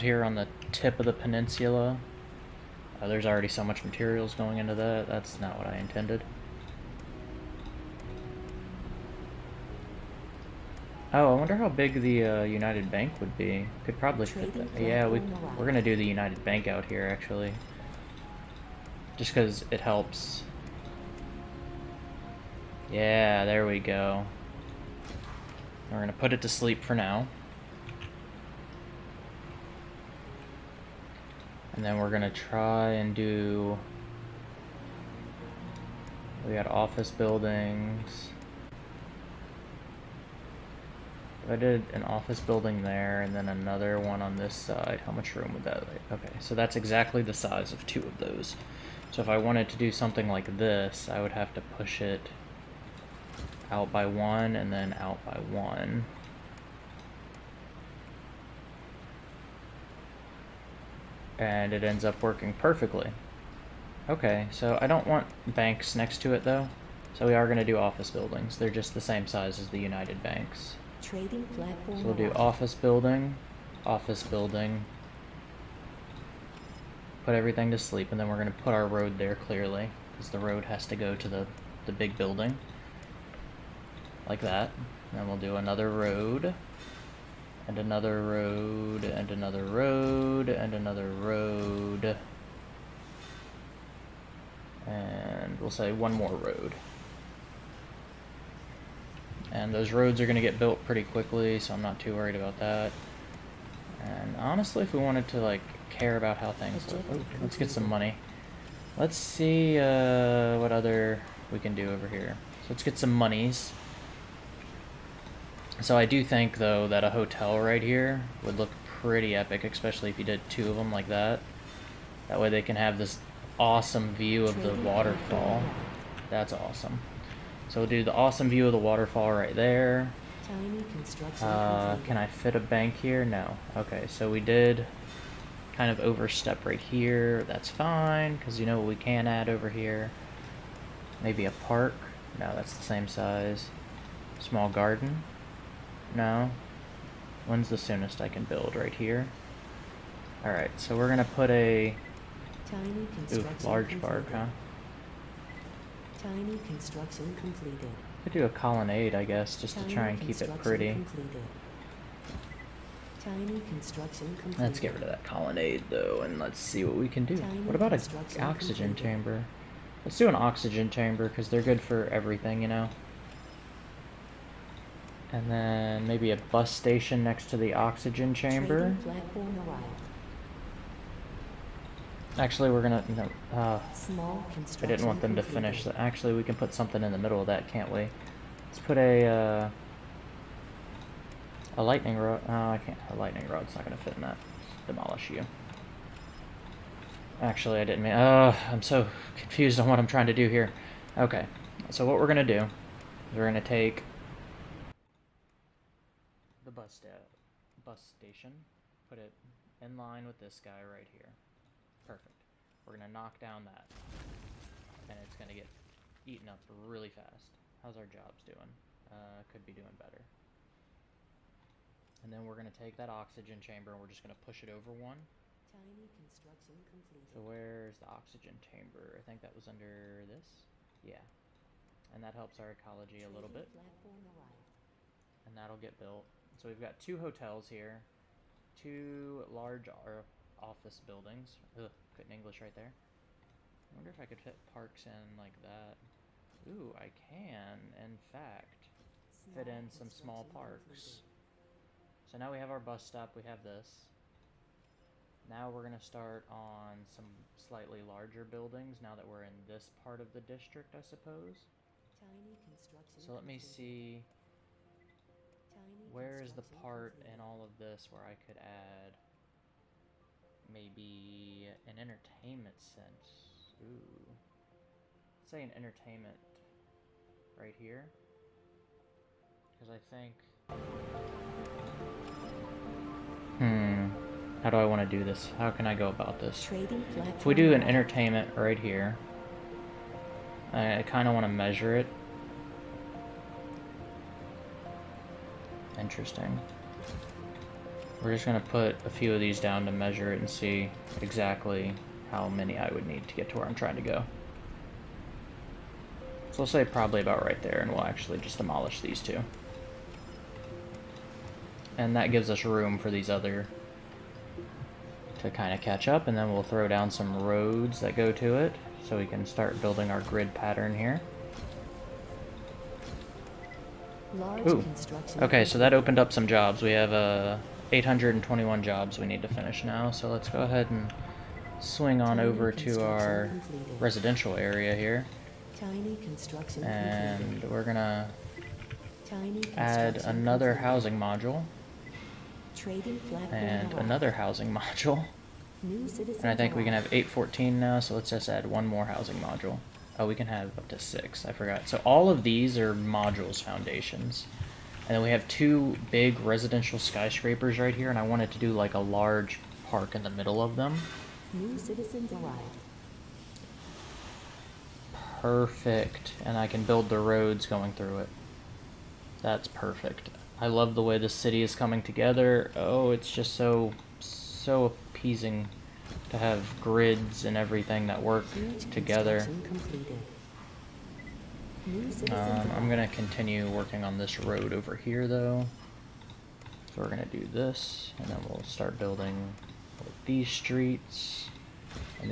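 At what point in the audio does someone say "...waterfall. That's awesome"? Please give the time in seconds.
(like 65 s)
124 s.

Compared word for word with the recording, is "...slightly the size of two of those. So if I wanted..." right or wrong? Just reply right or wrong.
wrong.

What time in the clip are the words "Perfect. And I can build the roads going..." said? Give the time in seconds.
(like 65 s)
365 s.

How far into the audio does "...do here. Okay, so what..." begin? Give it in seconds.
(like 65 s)
200 s.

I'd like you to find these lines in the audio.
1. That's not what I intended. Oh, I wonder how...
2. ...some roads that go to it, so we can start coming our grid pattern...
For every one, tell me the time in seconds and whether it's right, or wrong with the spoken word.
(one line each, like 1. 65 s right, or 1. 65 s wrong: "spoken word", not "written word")
1. 5 s right
2. 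317 s wrong: "building", not "coming".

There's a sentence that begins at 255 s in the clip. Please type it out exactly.
Now we're going to start on some slightly larger buildings now that we're in this part of the district, I suppose.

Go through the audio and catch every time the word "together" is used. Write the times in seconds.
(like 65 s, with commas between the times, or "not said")
372 s, 378 s.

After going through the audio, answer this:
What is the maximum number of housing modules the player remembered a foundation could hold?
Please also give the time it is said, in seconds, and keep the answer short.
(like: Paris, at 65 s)
6, at 350 s.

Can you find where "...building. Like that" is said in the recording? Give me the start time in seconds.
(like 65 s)
82 s.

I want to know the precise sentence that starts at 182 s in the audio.
Actually, we're gonna, you know, uh, I didn't want them to finish.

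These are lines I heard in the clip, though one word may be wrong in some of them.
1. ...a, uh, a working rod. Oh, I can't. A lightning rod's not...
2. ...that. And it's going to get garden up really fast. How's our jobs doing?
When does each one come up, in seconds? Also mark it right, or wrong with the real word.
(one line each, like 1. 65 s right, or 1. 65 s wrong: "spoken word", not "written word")
1. 188 s wrong: "lightning", not "working"
2. 213 s wrong: "eaten", not "garden".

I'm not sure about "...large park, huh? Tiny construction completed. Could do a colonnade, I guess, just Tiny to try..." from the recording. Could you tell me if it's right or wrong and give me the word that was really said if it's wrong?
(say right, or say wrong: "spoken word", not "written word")
right.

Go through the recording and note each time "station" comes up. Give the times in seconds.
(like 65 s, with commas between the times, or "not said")
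176 s, 208 s.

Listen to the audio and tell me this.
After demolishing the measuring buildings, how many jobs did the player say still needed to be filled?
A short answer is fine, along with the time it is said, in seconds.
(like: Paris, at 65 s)
821, at 327 s.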